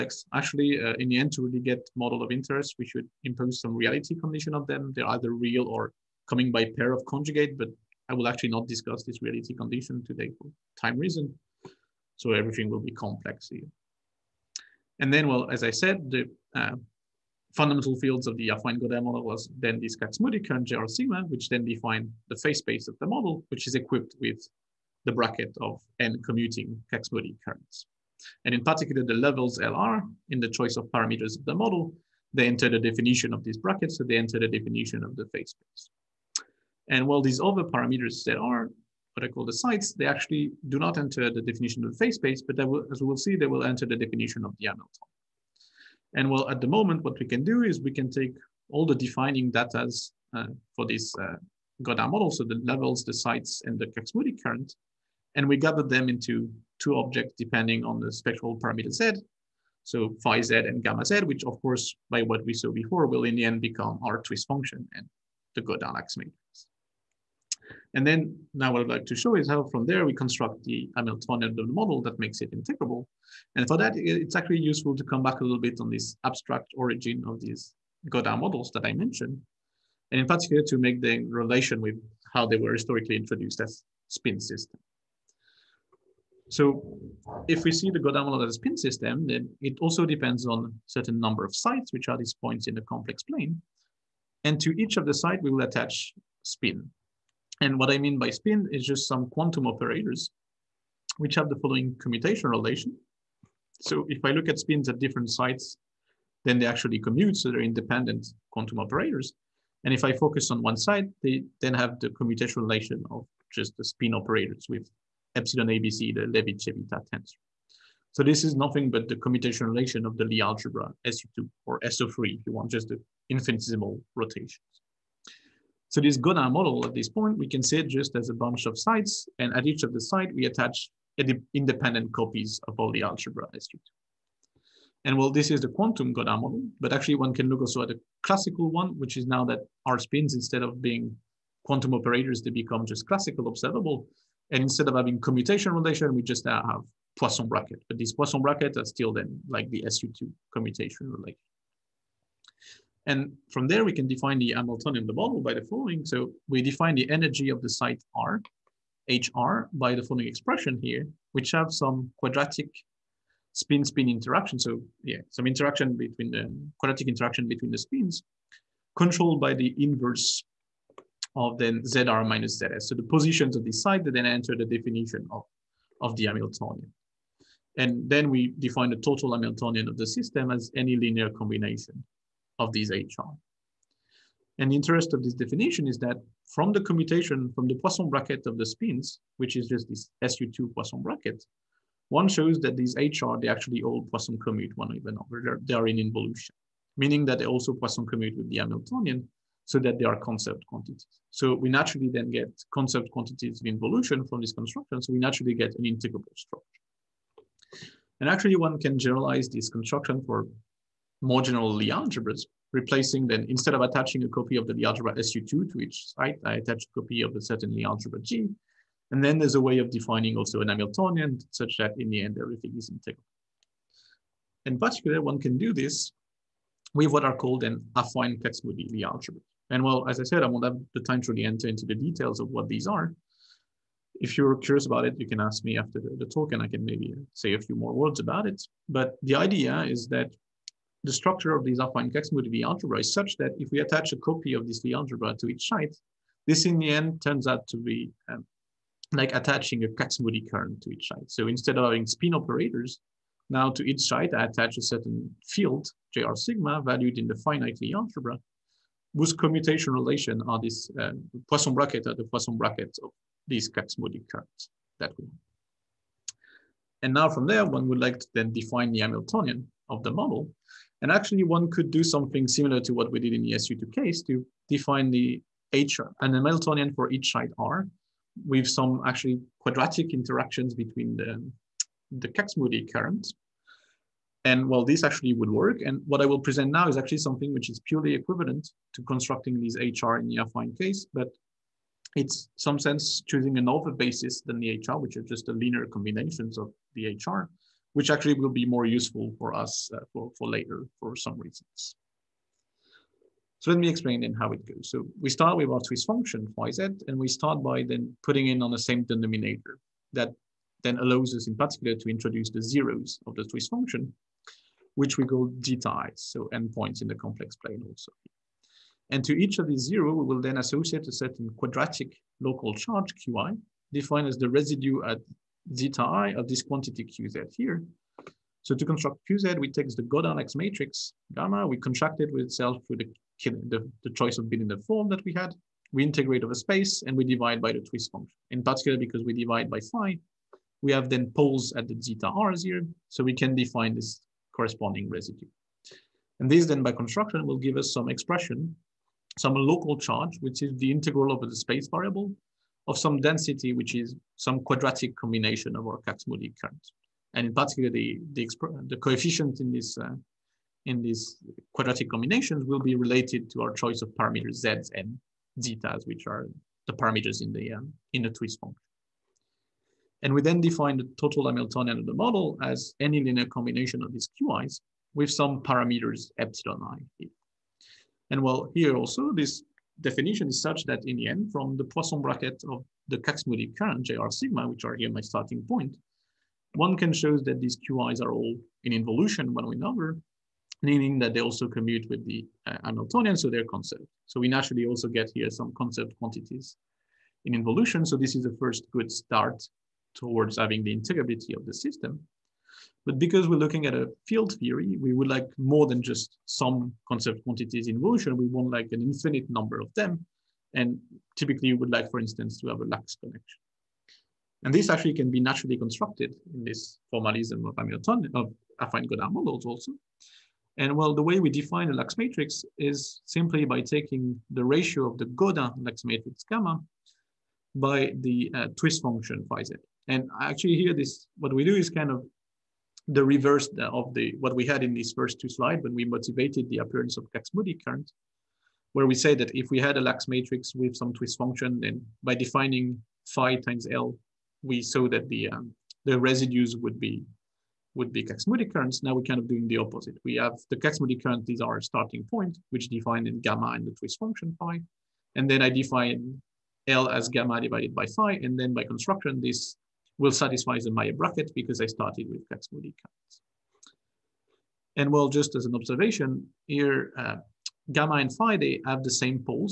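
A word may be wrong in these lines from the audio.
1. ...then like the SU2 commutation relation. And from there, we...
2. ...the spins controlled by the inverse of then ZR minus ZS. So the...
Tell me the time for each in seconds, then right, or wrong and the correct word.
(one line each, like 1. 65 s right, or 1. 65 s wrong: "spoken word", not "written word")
1. 149 s right
2. 167 s right.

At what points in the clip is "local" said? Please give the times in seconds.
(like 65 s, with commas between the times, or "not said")
322 s, 349 s.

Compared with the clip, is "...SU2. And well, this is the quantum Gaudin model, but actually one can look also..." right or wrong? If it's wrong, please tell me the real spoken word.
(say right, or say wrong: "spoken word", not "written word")
right.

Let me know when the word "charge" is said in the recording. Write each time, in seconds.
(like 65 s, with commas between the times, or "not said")
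322 s, 349 s.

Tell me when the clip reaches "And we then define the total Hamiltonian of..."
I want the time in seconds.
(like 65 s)
370 s.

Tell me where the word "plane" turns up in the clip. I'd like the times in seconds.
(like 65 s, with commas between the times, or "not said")
93 s, 317 s.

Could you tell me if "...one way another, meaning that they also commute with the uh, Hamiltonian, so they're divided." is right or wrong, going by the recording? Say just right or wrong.
wrong.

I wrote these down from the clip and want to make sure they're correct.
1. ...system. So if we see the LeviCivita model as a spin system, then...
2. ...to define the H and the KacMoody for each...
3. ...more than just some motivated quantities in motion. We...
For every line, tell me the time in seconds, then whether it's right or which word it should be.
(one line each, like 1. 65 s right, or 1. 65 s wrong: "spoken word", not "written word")
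1. 84 s wrong: "Gaudin", not "LeviCivita"
2. 274 s wrong: "Hamiltonian", not "KacMoody"
3. 405 s wrong: "conserved", not "motivated".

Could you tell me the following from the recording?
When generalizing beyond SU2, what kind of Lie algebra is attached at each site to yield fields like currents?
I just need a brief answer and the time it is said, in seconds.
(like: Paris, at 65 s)
Affine Kac-Moody Lie algebra, at 227 s.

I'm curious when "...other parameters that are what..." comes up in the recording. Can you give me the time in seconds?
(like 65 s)
37 s.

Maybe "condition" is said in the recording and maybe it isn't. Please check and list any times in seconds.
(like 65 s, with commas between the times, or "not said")
4 s, 9 s.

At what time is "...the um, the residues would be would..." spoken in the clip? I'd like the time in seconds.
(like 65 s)
445 s.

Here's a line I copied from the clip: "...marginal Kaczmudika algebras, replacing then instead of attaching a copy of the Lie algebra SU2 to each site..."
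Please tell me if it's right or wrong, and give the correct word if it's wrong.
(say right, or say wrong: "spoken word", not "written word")
wrong: "Lie", not "Kaczmudika".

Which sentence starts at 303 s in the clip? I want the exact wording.
So let me explain then how it goes.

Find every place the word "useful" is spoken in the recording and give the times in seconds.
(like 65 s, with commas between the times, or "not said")
74 s, 298 s.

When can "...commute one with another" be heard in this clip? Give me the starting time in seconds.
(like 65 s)
194 s.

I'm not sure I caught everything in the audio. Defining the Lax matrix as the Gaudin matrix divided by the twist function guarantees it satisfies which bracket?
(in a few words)
Maillet bracket.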